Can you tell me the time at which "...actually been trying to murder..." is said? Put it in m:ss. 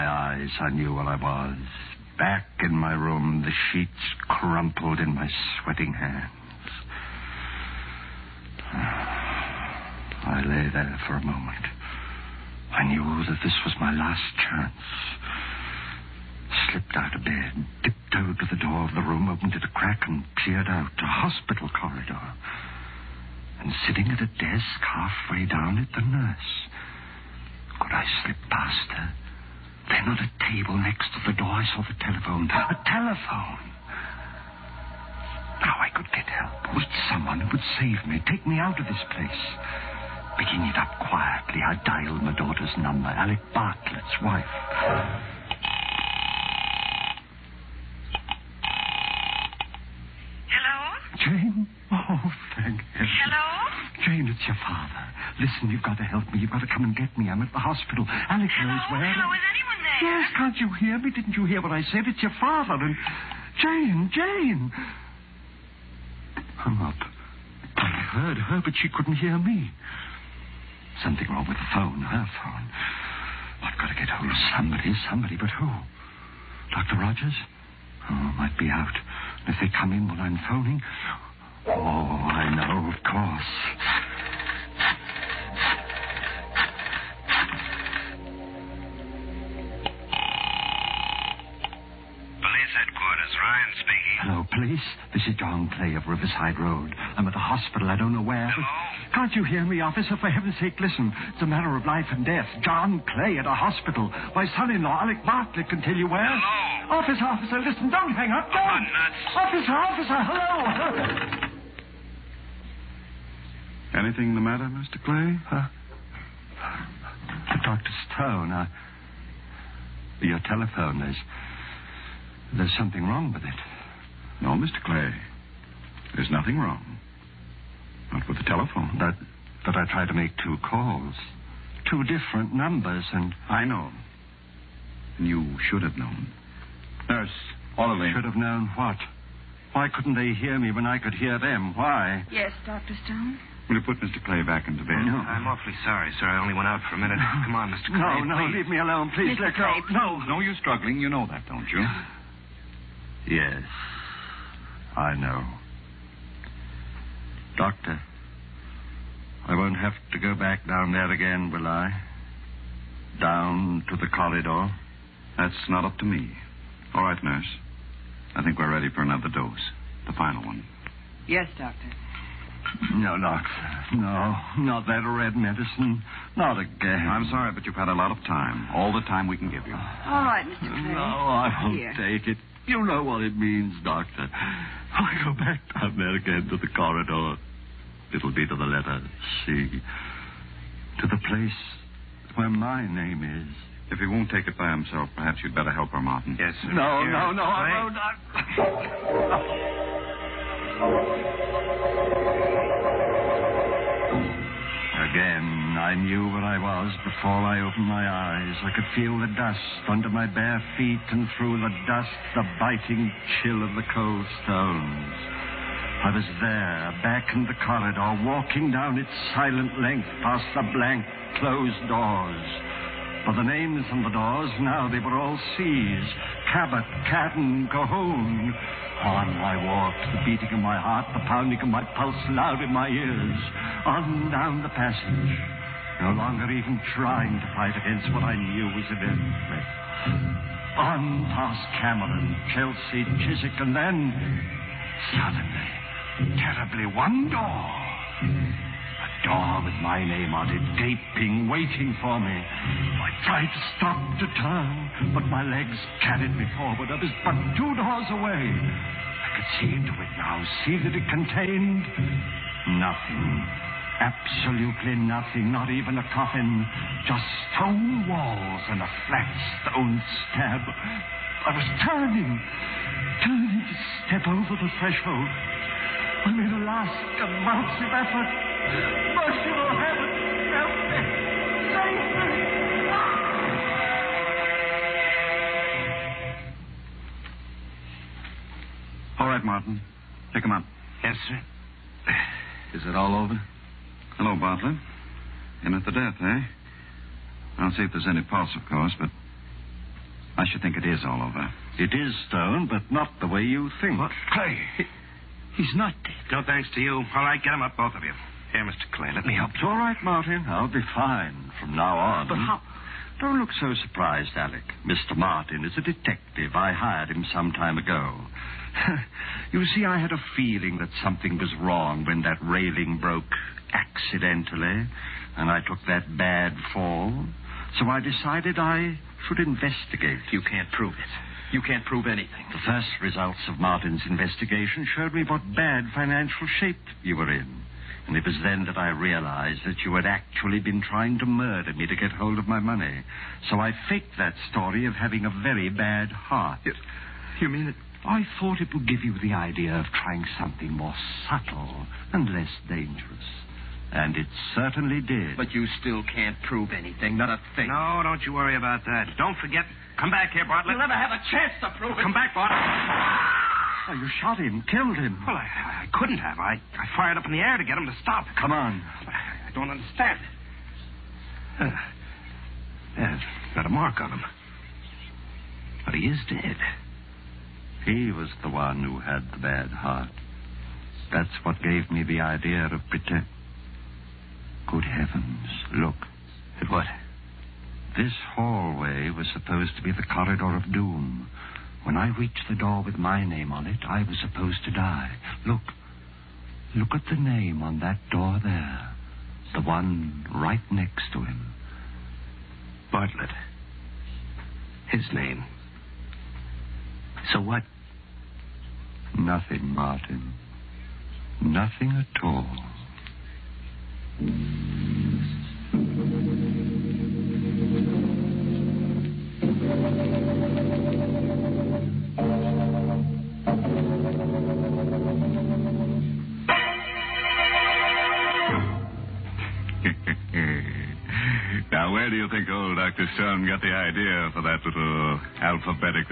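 5:40.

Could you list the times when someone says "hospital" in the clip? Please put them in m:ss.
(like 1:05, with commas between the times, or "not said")
0:21, 0:57, 1:37, 1:43.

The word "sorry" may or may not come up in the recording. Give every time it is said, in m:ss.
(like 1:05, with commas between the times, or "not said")
2:25, 2:57.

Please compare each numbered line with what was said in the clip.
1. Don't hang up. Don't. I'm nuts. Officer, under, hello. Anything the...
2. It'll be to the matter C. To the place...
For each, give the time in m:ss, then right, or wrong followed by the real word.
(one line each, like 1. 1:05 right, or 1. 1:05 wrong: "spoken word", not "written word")
1. 1:47 wrong: "officer", not "under"
2. 3:08 wrong: "letter", not "matter".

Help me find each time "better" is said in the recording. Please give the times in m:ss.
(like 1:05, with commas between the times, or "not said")
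3:15.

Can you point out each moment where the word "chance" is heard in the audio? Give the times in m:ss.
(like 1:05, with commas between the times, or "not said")
0:14, 6:01.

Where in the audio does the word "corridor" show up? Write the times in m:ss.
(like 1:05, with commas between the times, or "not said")
0:21, 2:44, 3:06, 3:37, 6:30.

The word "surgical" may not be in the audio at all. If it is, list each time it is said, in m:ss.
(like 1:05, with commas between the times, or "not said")
not said.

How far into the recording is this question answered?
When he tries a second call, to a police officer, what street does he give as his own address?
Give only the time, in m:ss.
1:36.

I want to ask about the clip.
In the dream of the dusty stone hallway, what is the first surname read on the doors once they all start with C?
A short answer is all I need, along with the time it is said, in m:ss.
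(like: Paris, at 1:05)
Cabot, at 3:46.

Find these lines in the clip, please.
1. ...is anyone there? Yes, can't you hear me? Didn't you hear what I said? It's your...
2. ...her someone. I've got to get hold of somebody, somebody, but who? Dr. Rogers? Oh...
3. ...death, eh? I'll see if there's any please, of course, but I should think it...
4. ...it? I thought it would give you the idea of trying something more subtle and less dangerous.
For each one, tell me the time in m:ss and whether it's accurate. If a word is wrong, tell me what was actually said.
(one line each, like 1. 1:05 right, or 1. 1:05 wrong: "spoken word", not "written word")
1. 0:59 right
2. 1:12 wrong: "phone", not "someone"
3. 4:55 wrong: "pulse", not "please"
4. 5:47 right.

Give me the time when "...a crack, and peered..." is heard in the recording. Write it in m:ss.
0:19.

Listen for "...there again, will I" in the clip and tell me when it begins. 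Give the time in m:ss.
2:40.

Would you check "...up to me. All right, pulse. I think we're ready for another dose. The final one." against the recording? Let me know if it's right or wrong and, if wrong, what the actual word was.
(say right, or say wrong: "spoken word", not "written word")
wrong: "nurse", not "pulse".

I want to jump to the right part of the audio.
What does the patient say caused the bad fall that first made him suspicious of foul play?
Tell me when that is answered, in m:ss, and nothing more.
5:22.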